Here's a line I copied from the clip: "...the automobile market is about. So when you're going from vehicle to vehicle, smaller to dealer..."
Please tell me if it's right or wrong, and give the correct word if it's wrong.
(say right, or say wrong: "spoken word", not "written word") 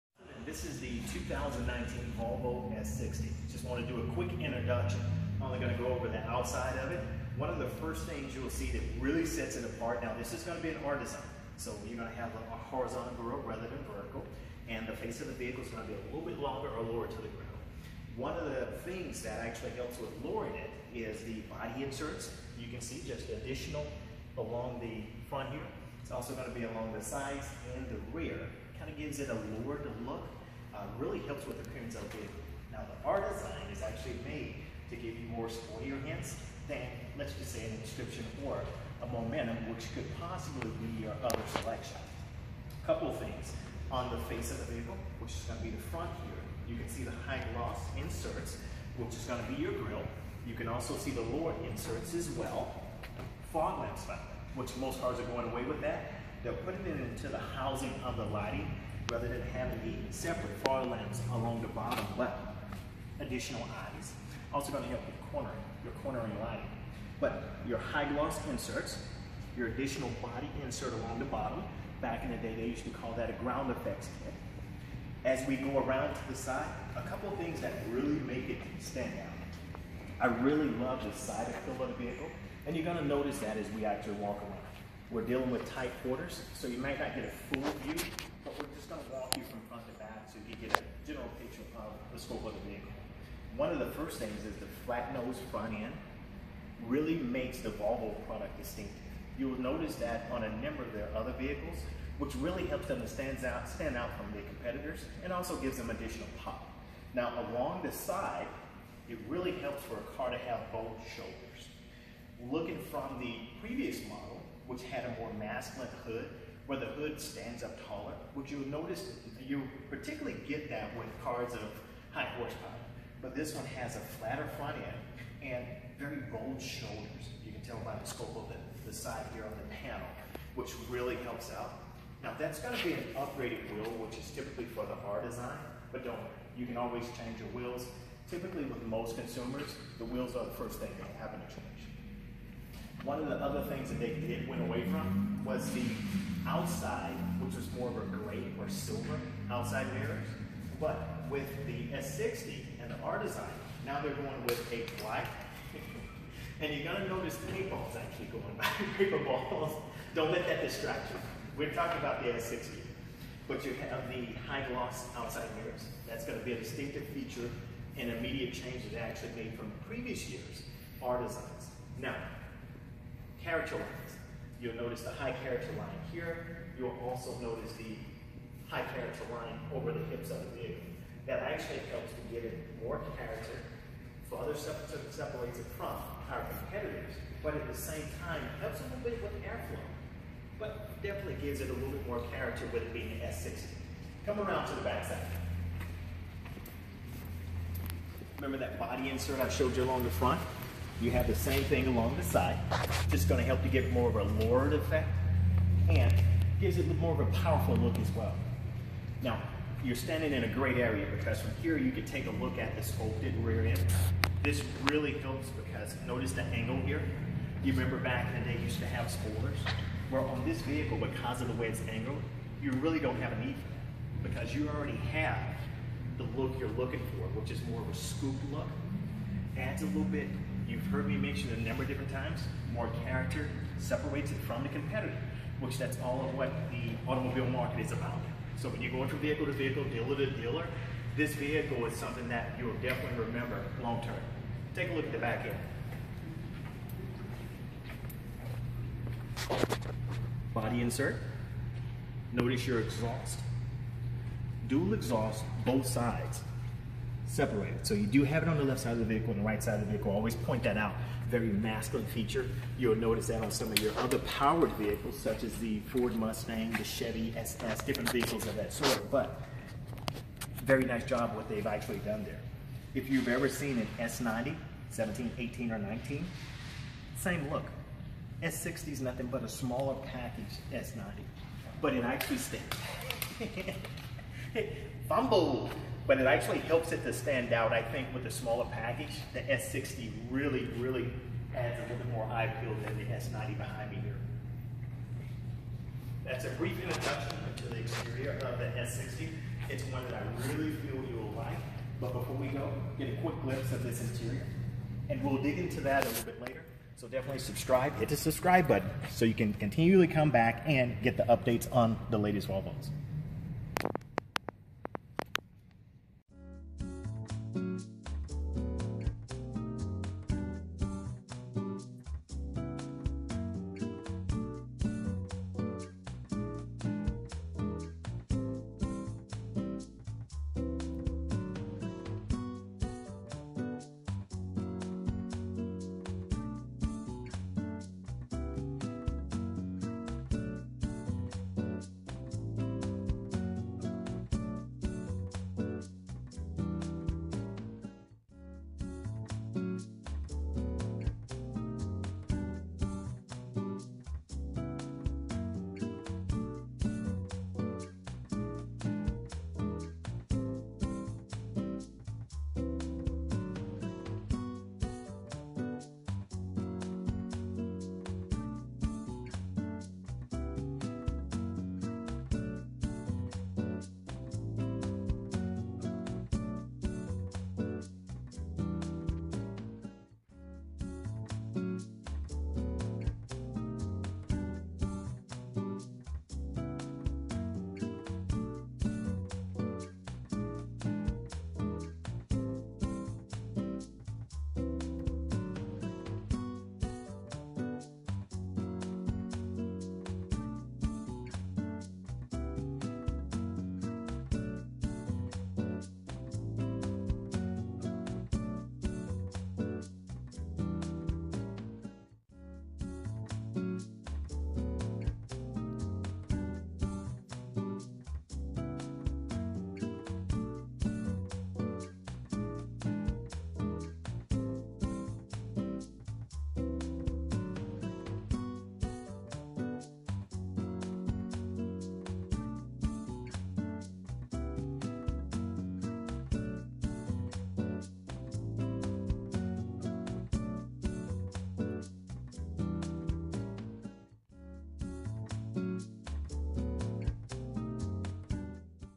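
wrong: "dealer", not "smaller".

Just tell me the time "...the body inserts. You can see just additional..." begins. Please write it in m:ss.
0:21.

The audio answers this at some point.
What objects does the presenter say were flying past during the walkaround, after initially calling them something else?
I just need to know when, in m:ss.
2:38.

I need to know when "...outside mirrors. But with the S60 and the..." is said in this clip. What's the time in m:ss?
2:29.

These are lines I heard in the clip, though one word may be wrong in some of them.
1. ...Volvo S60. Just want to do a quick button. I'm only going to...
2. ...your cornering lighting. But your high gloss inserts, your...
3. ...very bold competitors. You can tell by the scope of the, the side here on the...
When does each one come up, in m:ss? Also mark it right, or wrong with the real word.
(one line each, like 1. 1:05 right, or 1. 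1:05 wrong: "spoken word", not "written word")
1. 0:02 wrong: "introduction", not "button"
2. 1:05 right
3. 2:05 wrong: "shoulders", not "competitors".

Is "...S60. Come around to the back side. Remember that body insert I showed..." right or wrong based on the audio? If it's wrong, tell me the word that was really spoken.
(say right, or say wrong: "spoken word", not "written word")
right.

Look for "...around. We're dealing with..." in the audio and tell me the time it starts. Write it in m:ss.
1:24.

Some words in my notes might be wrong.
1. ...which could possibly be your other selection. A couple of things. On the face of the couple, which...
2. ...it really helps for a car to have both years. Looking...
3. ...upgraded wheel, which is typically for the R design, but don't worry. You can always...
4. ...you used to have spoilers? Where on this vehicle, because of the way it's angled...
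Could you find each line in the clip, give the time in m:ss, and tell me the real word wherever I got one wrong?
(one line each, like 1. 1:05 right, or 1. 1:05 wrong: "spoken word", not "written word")
1. 0:39 wrong: "vehicle", not "couple"
2. 1:49 wrong: "shoulders", not "years"
3. 2:13 right
4. 3:38 right.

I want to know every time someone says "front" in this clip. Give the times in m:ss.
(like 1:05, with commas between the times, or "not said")
0:25, 0:45, 1:29, 1:35, 2:04, 3:20.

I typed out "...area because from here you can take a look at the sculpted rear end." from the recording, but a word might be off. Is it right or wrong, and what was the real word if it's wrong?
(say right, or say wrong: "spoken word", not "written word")
right.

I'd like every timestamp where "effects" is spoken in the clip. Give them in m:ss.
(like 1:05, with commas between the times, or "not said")
1:13, 3:24.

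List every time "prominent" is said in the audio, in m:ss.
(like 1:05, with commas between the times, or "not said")
not said.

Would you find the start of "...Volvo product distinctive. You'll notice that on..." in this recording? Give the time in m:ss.
1:37.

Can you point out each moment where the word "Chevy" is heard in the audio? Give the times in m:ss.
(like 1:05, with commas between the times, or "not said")
4:26.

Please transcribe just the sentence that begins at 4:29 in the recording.
But very nice job what they've actually done there.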